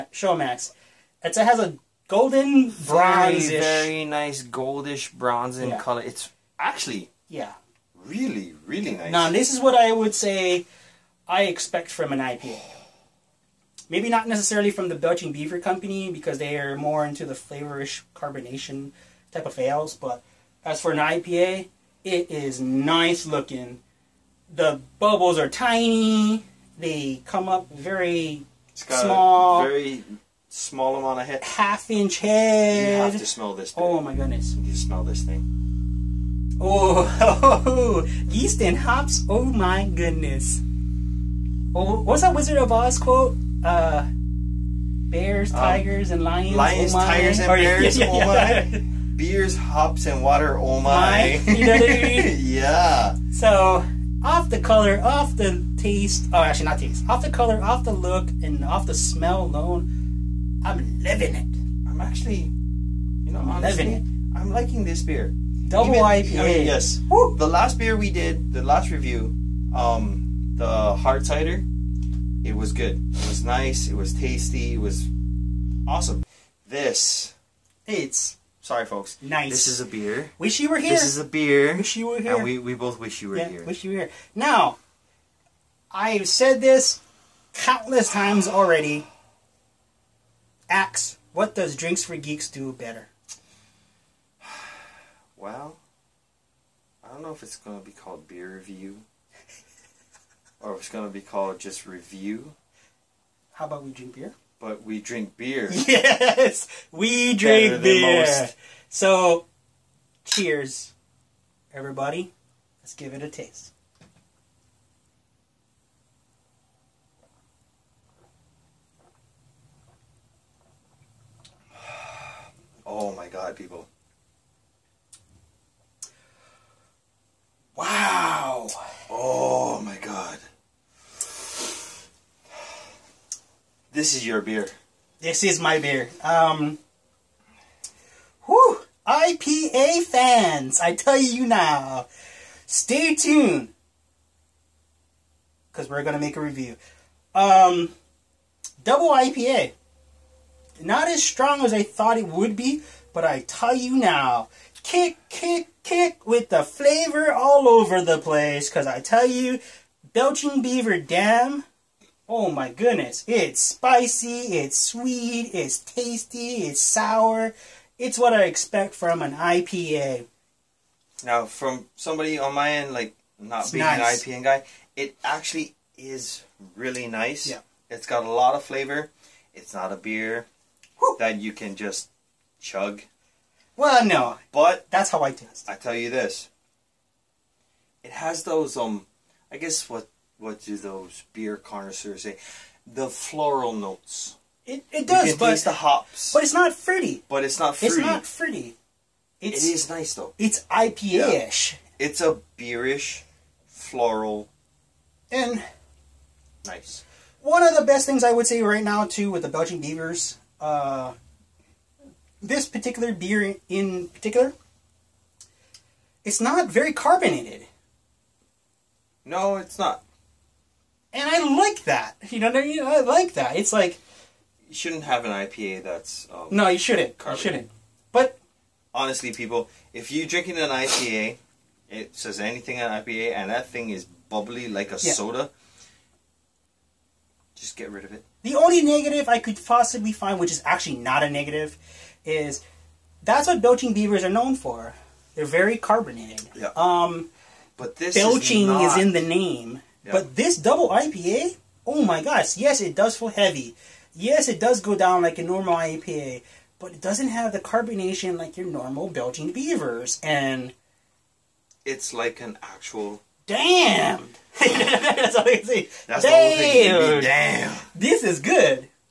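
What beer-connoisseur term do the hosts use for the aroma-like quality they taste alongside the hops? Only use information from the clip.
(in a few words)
floral notes.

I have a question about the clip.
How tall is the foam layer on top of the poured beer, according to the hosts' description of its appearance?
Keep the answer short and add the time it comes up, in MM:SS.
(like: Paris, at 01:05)
Half inch, at 00:31.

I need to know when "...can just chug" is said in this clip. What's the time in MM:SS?
03:01.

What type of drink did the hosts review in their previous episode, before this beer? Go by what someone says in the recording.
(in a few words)
Hard cider.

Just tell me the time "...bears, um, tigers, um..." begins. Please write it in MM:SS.
00:45.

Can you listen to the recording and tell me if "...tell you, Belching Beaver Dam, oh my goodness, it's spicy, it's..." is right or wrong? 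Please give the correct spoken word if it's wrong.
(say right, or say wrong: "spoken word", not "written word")
right.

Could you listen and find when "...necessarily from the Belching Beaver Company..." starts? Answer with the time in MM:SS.
00:14.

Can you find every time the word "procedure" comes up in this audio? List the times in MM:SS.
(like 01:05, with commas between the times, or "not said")
not said.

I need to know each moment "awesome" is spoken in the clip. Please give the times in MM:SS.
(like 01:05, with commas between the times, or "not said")
01:15.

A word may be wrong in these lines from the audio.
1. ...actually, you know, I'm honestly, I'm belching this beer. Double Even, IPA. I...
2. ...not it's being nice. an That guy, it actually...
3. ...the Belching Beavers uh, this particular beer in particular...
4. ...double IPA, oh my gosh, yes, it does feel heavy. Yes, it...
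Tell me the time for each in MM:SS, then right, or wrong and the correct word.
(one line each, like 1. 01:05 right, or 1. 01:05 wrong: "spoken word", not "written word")
1. 01:01 wrong: "liking", not "belching"
2. 02:53 wrong: "IPA", not "That"
3. 03:29 right
4. 04:10 right.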